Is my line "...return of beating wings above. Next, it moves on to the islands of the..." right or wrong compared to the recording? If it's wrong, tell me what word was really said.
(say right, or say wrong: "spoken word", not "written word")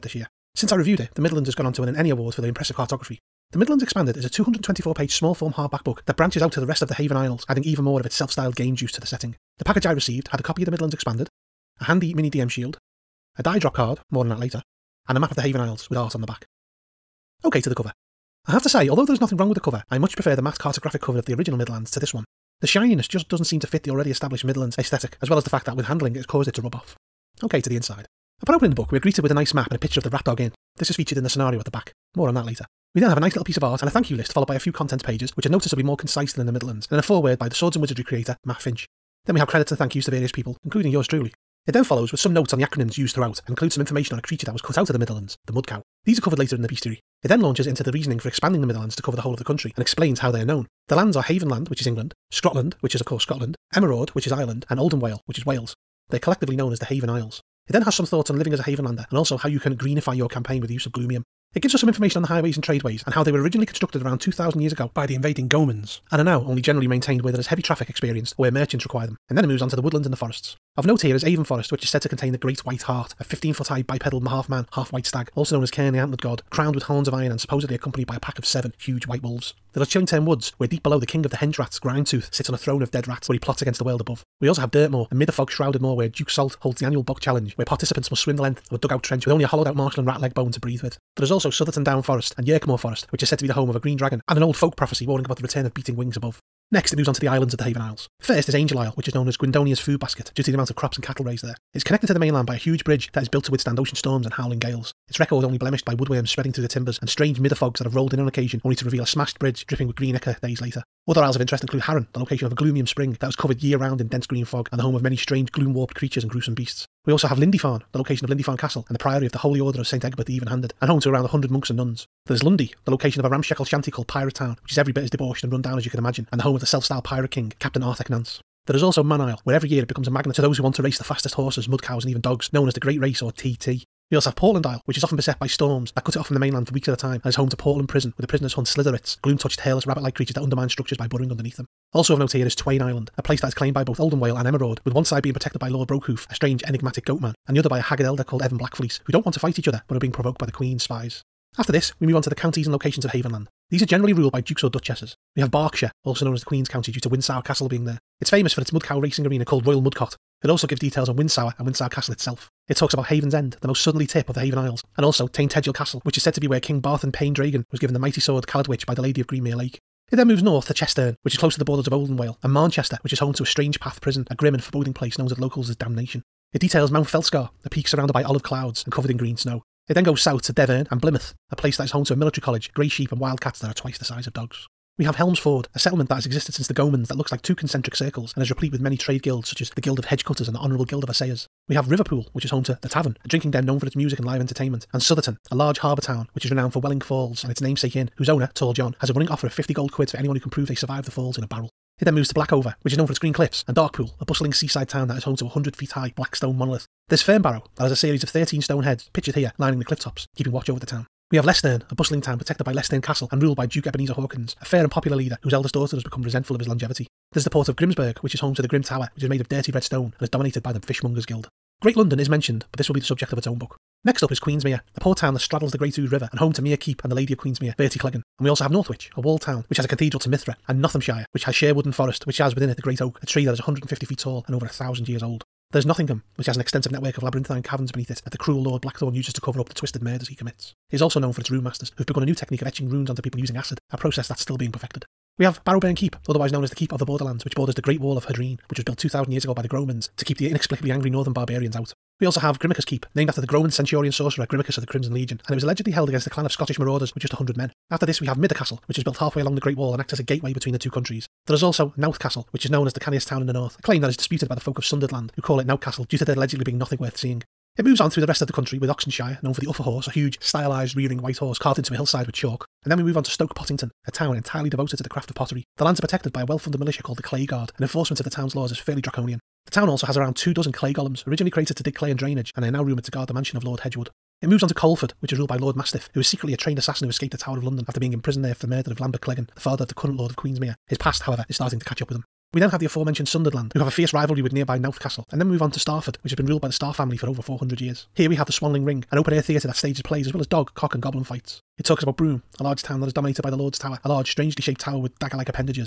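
right.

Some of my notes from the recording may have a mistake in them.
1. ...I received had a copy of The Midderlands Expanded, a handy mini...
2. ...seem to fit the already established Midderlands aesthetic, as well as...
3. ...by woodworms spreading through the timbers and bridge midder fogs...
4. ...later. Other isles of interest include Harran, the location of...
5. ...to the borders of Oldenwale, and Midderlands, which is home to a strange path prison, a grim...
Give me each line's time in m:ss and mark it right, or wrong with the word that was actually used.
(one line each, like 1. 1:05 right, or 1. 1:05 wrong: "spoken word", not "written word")
1. 0:09 right
2. 0:23 right
3. 1:45 wrong: "strange", not "bridge"
4. 1:50 right
5. 2:51 wrong: "Manchester", not "Midderlands".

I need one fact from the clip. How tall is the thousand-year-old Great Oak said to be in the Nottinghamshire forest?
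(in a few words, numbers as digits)
150 feet.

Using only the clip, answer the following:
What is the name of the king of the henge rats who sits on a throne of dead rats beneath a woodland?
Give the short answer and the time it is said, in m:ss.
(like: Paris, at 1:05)
Grindtooth, at 1:21.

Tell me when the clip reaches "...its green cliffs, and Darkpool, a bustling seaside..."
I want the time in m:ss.
3:23.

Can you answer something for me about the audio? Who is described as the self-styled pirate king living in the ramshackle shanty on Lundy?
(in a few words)
Captain Arthur Nance.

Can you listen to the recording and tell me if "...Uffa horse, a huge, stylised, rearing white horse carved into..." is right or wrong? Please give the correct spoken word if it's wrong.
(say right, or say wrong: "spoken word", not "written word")
right.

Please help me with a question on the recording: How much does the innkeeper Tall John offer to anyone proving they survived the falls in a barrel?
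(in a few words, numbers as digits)
50 gold quids.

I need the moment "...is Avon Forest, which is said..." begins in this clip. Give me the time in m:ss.
1:11.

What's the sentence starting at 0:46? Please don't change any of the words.
These are covered later in the bestiary.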